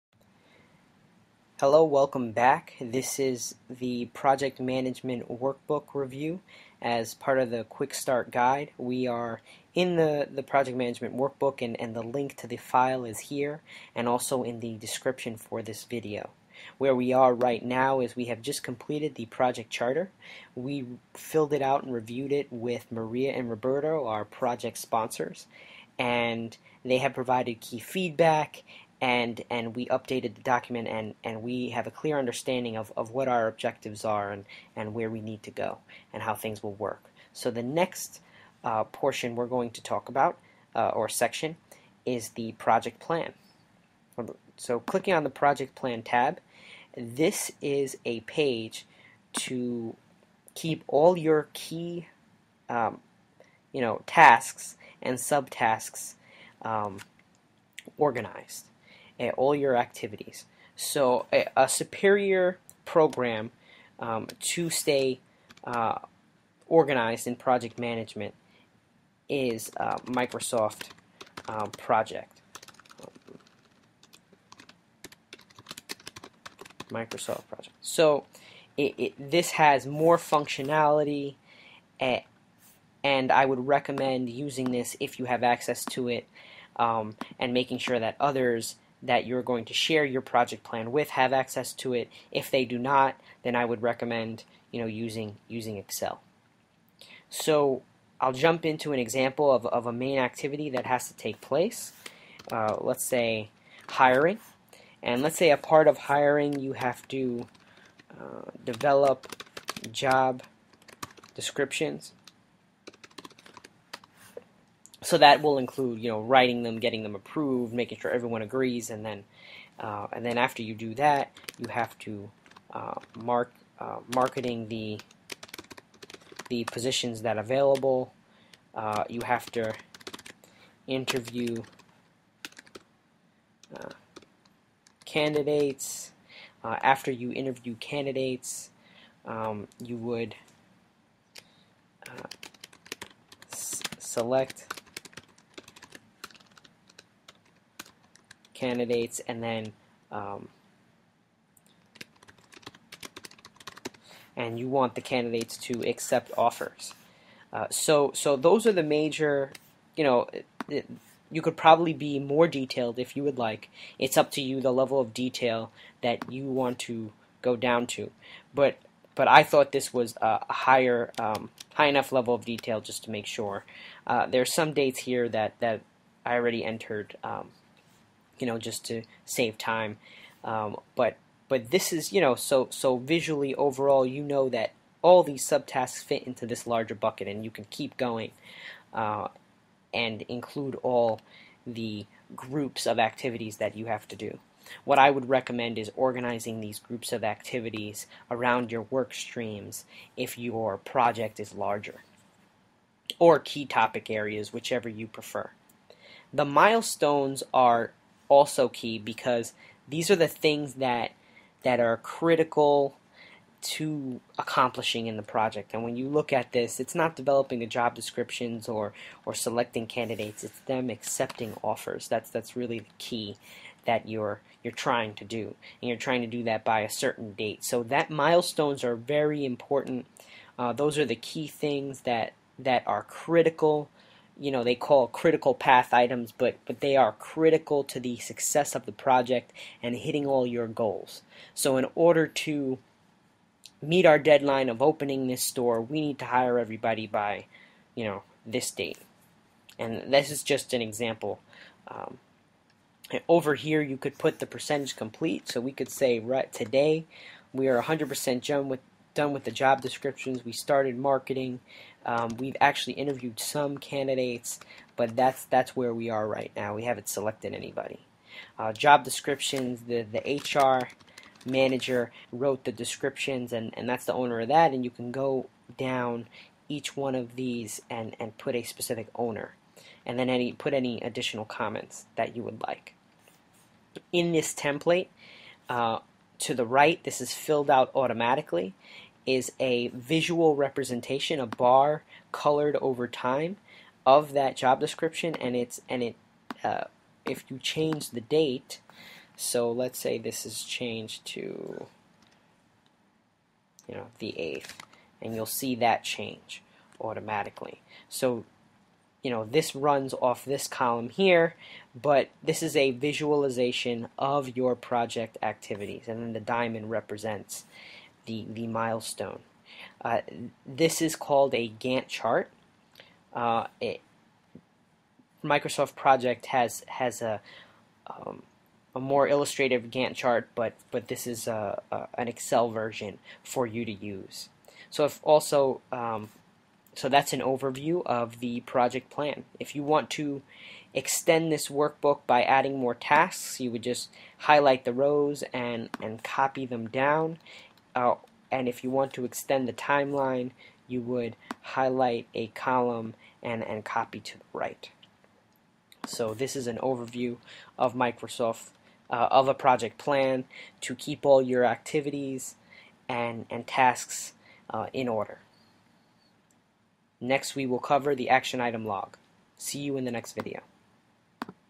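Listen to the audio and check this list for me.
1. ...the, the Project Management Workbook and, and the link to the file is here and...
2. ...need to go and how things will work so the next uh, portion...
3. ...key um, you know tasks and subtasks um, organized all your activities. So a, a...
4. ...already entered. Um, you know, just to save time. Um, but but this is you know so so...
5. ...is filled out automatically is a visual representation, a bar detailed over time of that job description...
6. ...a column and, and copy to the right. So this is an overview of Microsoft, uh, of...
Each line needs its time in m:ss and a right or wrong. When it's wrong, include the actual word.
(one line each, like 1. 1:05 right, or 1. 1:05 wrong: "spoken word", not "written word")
1. 0:09 right
2. 0:35 right
3. 0:51 right
4. 2:56 right
5. 4:47 wrong: "colored", not "detailed"
6. 5:52 right.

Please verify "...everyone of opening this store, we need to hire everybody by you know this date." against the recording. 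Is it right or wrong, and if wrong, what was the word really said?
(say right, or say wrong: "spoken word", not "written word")
wrong: "deadline", not "everyone".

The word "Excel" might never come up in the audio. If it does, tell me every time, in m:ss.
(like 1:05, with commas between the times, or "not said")
1:35, 5:32.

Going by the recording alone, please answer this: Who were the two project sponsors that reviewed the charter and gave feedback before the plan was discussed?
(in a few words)
Maria and Roberto.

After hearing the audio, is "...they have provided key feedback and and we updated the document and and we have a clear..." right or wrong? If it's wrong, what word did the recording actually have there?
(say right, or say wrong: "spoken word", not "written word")
right.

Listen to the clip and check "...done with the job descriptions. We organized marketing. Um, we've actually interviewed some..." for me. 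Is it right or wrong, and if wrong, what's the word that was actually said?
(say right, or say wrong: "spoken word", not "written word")
wrong: "started", not "organized".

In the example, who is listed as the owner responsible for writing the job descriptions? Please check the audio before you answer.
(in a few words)
HR manager.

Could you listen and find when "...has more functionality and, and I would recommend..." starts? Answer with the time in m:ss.
1:19.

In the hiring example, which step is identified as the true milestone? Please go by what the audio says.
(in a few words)
Accepting offers.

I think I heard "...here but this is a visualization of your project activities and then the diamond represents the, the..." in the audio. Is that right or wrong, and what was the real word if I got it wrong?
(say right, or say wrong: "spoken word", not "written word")
right.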